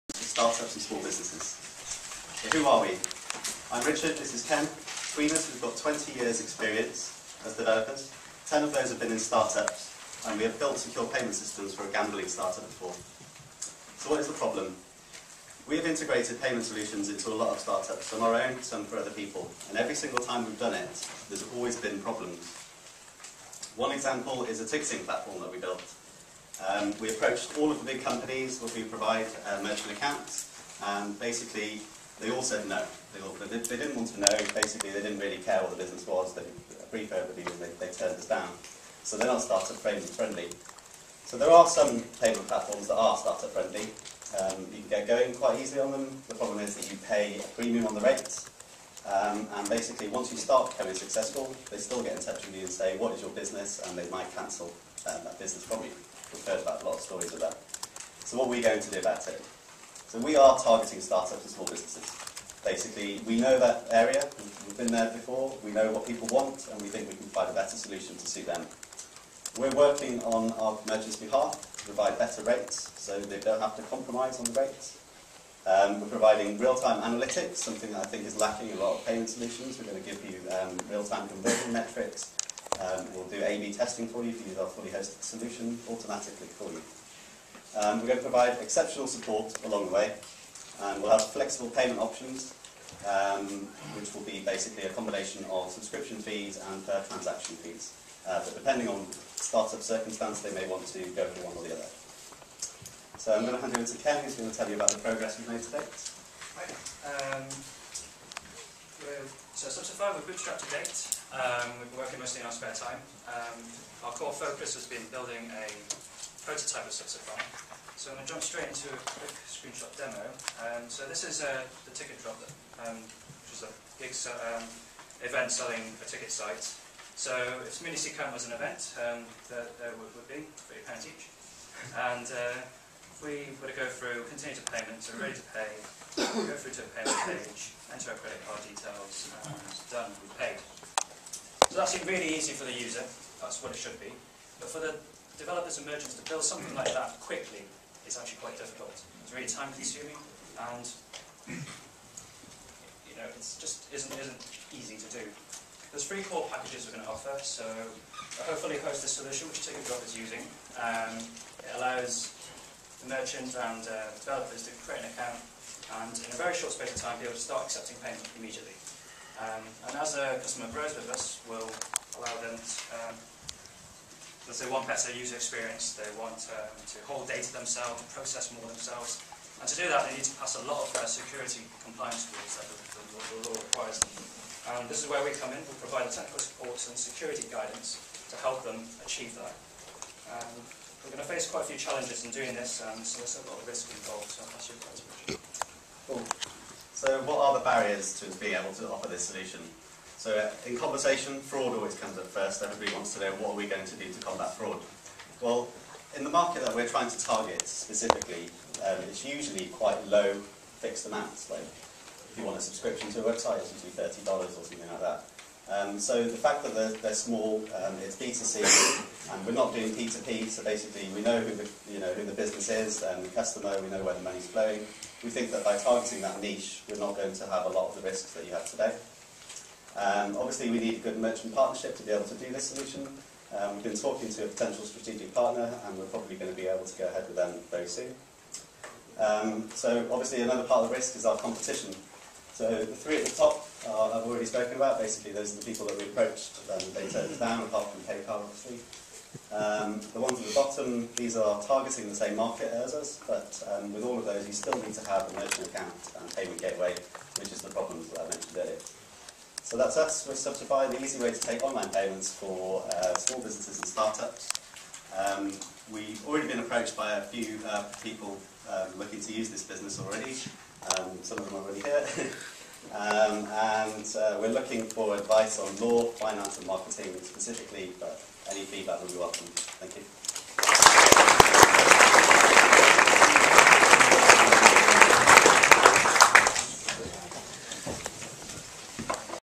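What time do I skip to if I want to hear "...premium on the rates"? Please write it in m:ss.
0:47.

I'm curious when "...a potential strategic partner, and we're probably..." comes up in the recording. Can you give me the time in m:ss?
3:54.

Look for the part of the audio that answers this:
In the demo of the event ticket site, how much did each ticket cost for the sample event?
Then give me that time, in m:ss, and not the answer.
2:10.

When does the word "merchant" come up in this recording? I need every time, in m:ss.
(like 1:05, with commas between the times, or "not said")
0:29, 1:10, 2:25, 2:43, 3:51, 4:15.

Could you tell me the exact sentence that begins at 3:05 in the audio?
We'll provide technical support and security guidance to help them achieve that.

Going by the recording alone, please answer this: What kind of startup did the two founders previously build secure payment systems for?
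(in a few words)
gambling startup.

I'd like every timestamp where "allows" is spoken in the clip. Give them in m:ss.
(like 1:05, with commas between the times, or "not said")
2:41, 2:52.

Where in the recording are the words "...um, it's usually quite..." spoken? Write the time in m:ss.
3:28.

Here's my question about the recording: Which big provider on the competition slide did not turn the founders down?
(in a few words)
PayPal.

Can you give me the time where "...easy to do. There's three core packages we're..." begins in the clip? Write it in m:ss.
2:34.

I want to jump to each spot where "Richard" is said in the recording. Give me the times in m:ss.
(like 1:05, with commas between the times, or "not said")
0:03, 3:15.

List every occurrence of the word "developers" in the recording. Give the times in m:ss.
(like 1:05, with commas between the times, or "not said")
0:07, 2:25, 2:44.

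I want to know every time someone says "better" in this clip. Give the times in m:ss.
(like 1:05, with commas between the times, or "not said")
1:07, 1:12, 2:54.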